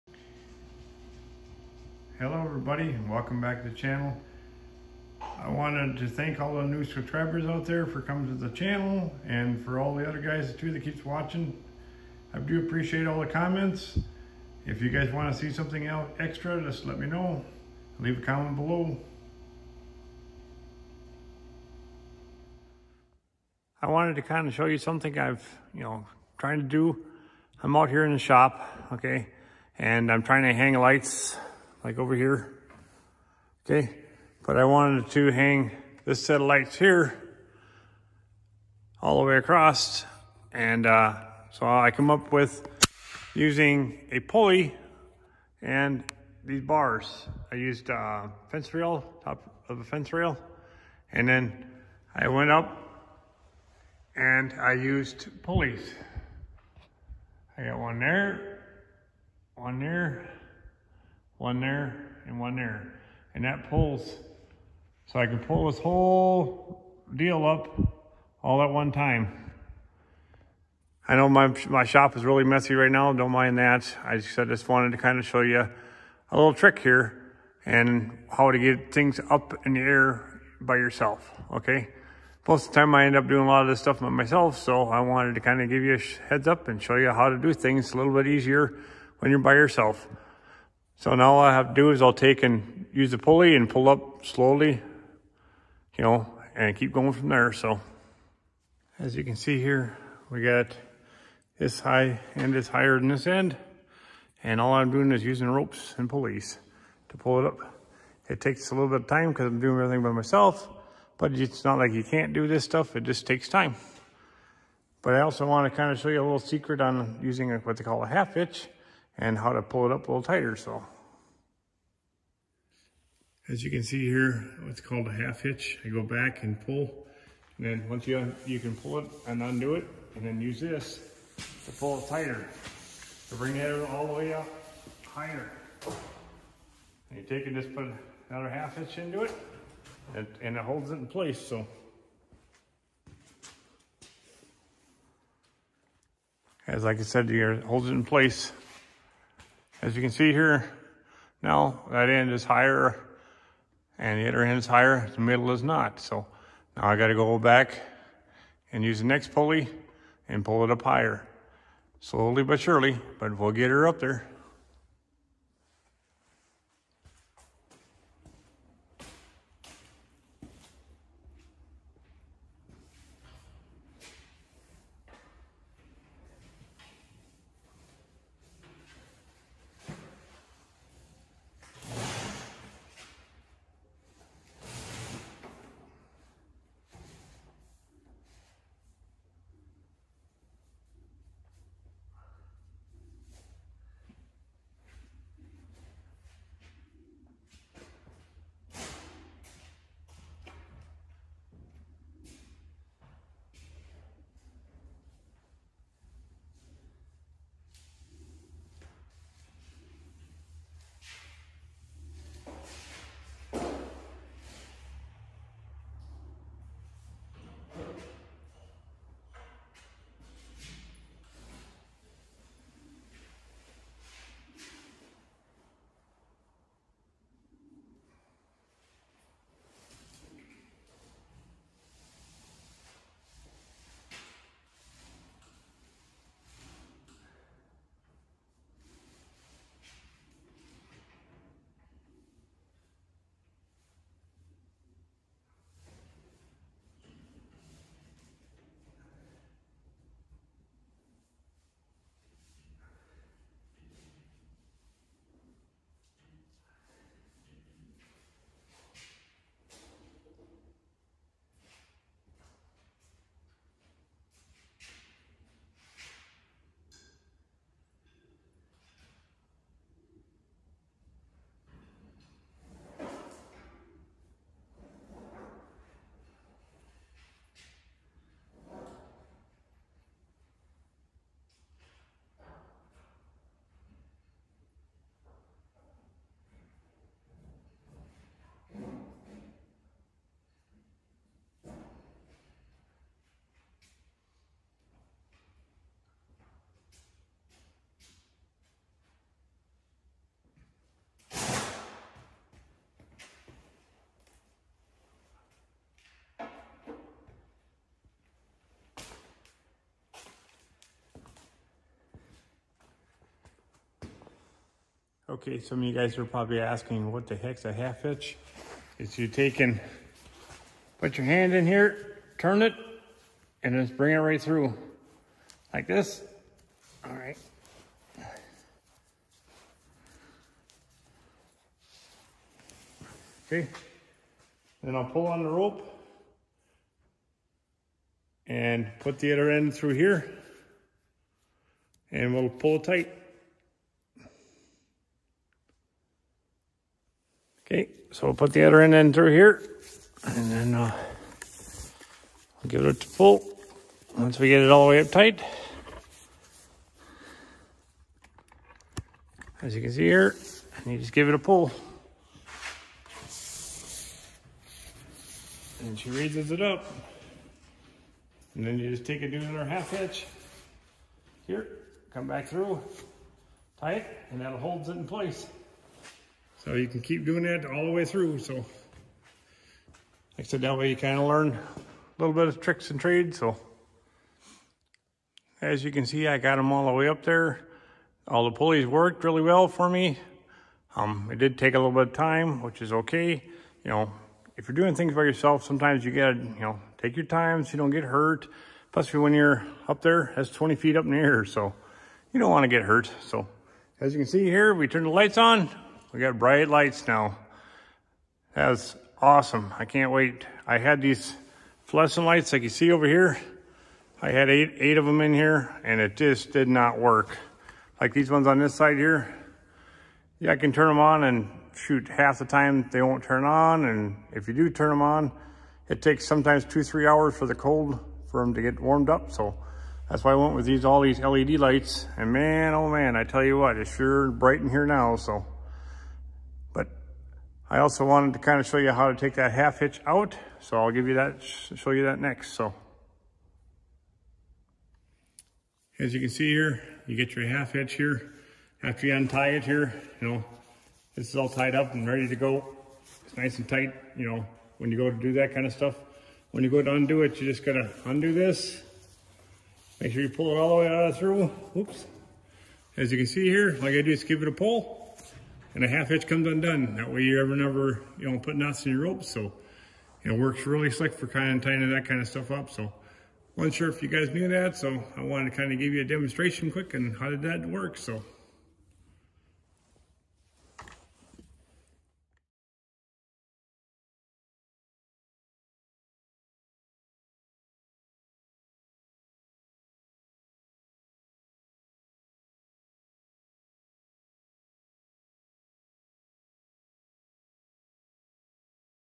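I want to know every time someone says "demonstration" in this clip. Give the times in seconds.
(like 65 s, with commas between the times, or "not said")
476 s.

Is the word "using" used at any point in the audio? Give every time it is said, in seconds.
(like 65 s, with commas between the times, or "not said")
43 s, 105 s, 117 s.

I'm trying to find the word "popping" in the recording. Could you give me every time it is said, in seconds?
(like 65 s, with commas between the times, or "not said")
not said.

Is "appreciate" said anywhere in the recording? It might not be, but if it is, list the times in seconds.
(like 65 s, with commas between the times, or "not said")
12 s.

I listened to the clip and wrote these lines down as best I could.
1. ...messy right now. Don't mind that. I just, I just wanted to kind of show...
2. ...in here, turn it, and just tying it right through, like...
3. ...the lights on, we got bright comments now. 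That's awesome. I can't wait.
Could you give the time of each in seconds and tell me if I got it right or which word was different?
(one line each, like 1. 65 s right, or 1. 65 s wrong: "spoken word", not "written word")
1. 72 s right
2. 321 s wrong: "bring", not "tying"
3. 405 s wrong: "lights", not "comments".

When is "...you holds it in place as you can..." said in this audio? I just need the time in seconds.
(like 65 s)
147 s.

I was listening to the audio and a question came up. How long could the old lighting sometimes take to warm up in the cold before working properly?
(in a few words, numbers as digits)
2 to 3 hours.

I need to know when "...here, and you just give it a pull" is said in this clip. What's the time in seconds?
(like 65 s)
360 s.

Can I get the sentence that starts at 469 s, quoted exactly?
So it works really slick for kind of tying that kind of stuff up.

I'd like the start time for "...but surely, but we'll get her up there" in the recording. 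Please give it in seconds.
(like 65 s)
162 s.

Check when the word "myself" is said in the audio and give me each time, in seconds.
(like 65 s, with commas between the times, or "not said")
84 s, 110 s.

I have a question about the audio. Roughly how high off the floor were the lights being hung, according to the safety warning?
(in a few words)
20 feet.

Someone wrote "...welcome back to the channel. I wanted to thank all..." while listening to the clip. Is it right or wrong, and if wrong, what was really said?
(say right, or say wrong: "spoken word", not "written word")
right.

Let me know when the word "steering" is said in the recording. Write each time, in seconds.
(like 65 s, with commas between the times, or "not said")
not said.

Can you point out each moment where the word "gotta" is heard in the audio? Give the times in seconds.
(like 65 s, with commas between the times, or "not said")
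156 s, 396 s, 457 s.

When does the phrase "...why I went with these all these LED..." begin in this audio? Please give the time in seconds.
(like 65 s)
430 s.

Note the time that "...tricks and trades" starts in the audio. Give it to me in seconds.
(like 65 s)
382 s.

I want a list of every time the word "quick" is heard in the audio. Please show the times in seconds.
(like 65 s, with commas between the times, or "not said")
476 s.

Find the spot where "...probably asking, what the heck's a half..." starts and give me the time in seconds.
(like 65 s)
316 s.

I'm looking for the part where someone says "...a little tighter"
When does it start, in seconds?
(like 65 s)
120 s.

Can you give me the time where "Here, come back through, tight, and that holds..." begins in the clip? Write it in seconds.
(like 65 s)
371 s.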